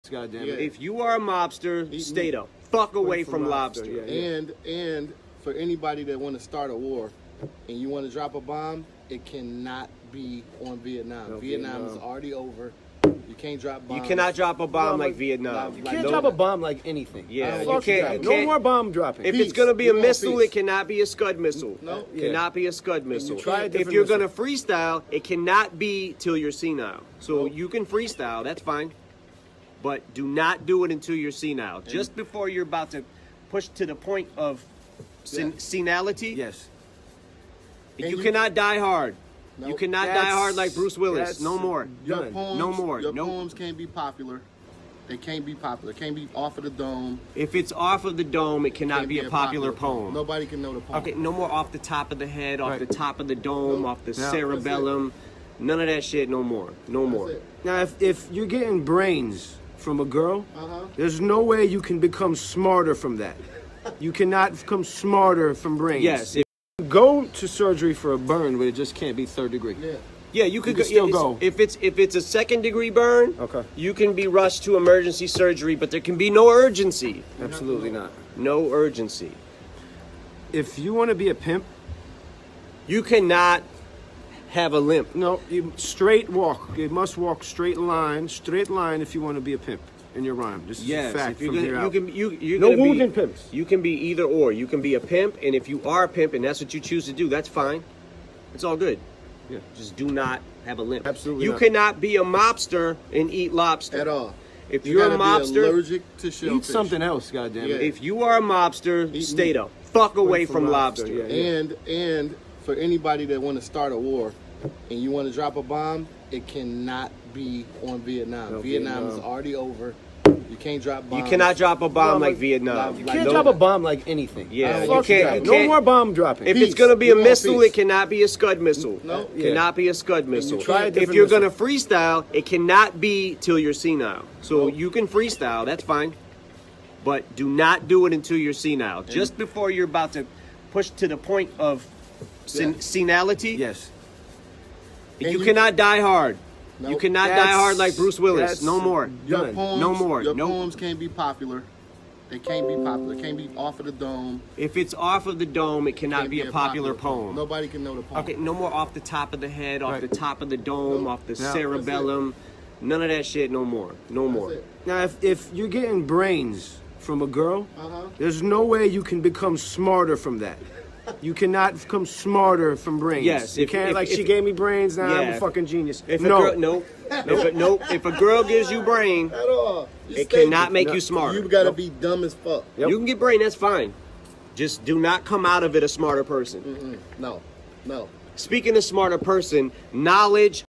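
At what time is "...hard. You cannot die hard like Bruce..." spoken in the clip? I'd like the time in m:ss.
2:26.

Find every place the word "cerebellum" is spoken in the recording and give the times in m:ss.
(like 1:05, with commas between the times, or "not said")
0:54, 2:41.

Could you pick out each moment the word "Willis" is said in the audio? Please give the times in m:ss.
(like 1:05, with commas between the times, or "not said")
0:40, 2:28.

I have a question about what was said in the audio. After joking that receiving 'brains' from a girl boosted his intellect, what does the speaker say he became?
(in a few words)
genius.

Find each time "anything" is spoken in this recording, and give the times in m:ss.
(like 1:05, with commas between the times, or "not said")
0:16, 2:04.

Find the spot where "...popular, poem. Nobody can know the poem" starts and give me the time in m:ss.
2:36.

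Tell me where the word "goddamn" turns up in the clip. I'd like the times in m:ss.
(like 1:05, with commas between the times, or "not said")
1:47.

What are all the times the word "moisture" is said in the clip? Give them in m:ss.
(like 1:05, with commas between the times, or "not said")
not said.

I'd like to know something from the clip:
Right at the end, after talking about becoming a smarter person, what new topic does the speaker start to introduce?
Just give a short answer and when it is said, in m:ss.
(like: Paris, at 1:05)
knowledge, at 3:09.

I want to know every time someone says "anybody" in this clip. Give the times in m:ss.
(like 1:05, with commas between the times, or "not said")
0:05, 1:52.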